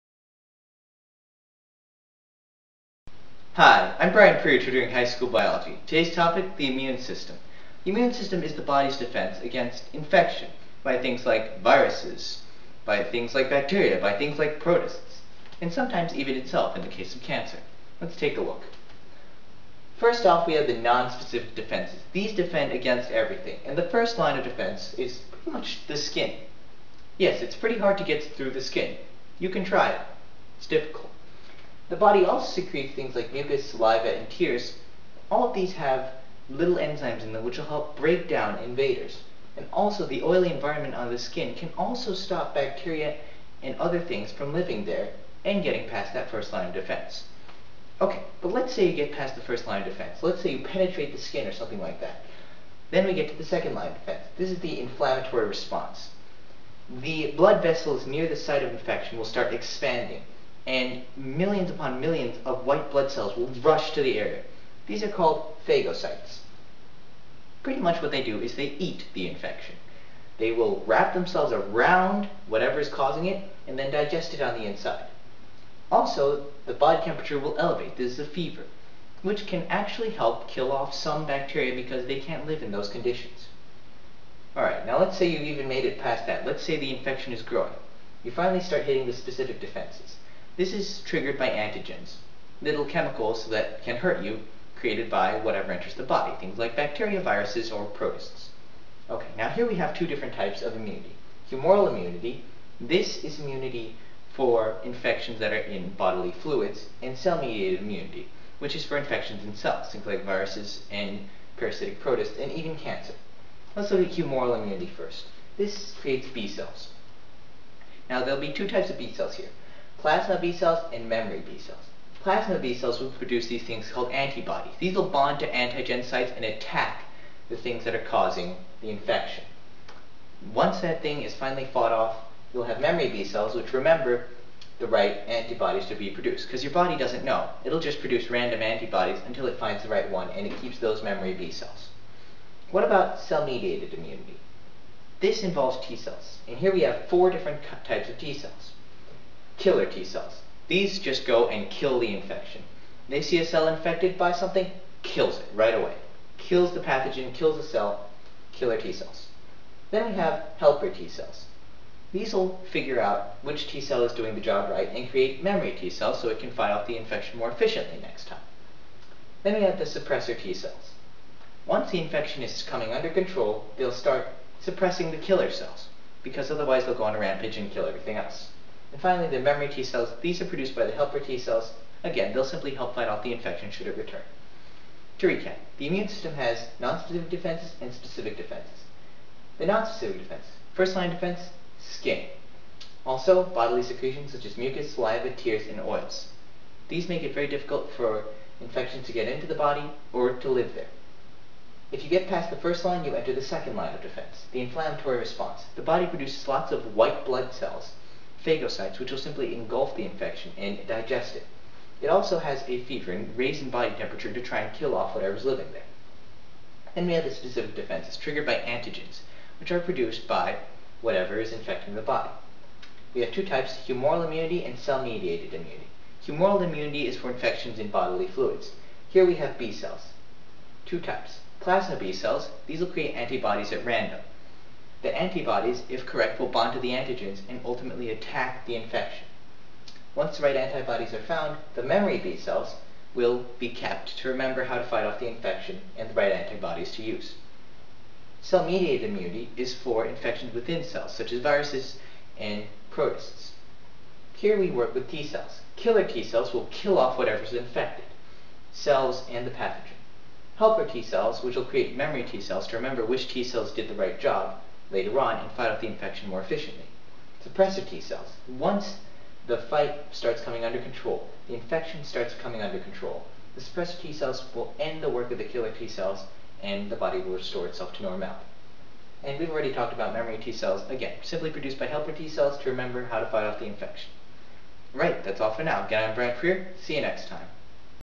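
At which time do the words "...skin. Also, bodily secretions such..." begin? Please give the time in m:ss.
3:11.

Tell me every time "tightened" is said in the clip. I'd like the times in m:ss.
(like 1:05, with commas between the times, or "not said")
not said.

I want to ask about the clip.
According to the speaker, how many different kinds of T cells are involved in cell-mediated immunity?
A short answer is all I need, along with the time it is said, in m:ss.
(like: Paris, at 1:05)
4, at 2:27.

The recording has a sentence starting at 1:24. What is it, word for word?
Alright, now let's say you've even made it past that.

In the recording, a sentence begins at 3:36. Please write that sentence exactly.
And we have the specific defenses triggered by antigens, which are produced by whatever is infecting the body.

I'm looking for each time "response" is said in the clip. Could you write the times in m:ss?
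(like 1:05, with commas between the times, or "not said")
0:55, 3:25.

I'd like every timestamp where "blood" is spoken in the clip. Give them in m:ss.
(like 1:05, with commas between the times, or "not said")
0:57, 1:02, 3:27.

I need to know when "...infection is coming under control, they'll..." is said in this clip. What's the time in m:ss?
2:52.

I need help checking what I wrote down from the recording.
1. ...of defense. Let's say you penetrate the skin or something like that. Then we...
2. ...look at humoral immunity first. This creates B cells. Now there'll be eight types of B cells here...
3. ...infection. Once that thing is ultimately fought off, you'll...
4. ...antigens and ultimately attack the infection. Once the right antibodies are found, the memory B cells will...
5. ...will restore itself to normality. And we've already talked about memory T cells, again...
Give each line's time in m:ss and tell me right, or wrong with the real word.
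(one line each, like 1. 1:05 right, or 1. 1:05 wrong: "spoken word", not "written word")
1. 0:49 right
2. 1:53 wrong: "two", not "eight"
3. 2:08 wrong: "finally", not "ultimately"
4. 3:56 right
5. 4:37 right.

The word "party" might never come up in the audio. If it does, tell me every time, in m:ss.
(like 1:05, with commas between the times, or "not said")
not said.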